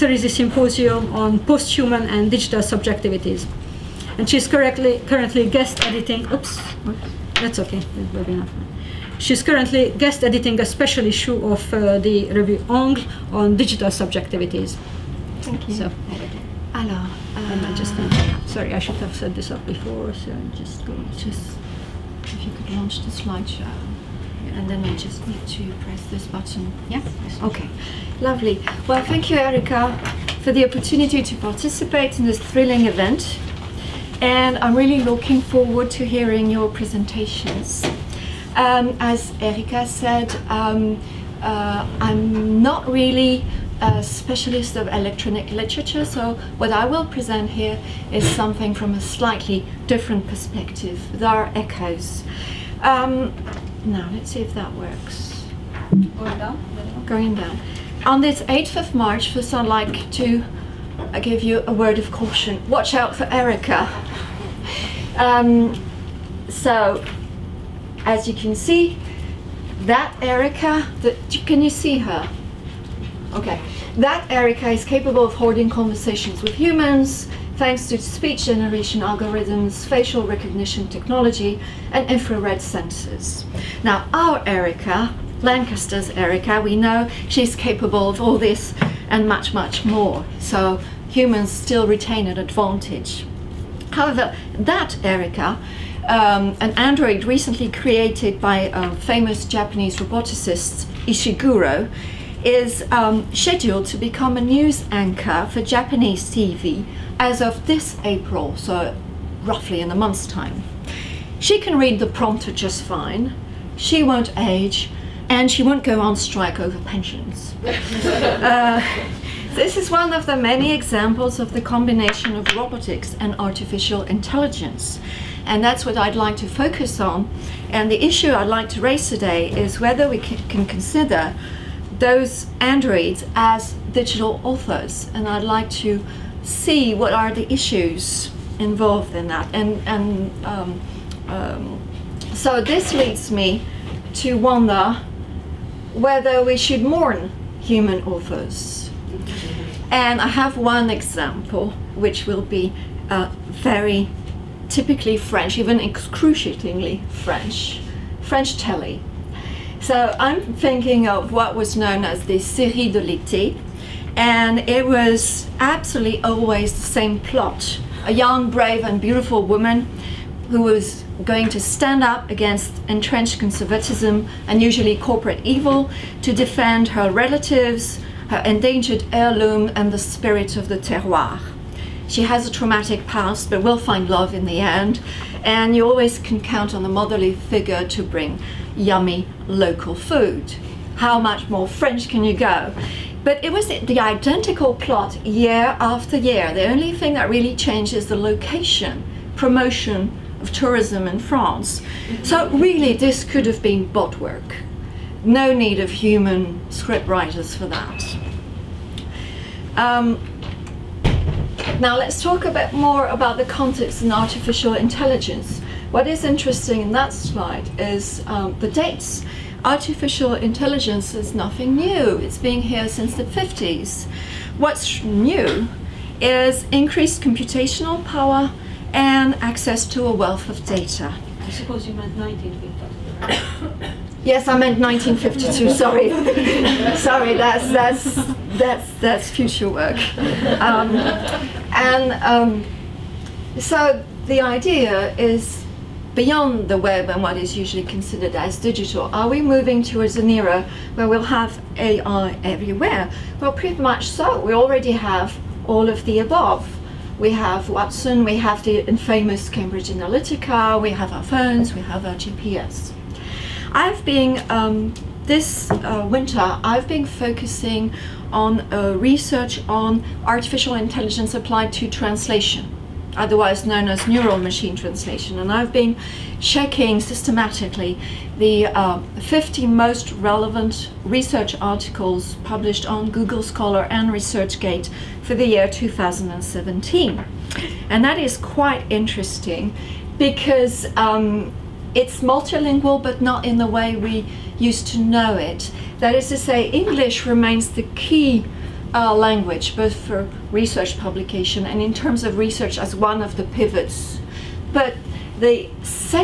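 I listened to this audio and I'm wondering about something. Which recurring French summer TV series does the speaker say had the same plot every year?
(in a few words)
Série de l'été.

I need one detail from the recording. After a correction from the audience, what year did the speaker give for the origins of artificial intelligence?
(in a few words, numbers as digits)
1952.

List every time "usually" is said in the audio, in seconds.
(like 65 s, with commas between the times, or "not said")
174 s, 247 s.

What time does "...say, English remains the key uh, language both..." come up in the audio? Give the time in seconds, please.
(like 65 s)
296 s.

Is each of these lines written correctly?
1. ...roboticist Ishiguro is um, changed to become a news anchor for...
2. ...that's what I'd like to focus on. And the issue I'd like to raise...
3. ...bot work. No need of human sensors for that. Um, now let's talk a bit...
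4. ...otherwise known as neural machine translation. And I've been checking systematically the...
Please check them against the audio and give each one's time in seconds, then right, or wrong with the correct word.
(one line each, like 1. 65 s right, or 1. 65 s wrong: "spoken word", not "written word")
1. 99 s wrong: "scheduled", not "changed"
2. 125 s right
3. 203 s wrong: "scriptwriters", not "sensors"
4. 273 s right.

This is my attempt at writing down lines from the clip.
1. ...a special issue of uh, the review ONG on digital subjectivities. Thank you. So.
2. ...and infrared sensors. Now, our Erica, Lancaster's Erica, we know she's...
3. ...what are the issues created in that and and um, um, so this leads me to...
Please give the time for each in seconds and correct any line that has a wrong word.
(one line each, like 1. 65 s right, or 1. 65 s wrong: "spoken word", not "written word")
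1. 10 s right
2. 81 s right
3. 136 s wrong: "involved", not "created".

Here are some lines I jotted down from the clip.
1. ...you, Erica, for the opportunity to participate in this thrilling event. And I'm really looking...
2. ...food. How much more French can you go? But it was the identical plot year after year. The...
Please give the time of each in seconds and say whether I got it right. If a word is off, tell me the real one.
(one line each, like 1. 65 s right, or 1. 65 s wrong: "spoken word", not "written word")
1. 29 s right
2. 189 s right.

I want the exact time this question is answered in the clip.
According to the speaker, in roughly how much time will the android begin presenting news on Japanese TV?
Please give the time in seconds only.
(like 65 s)
109 s.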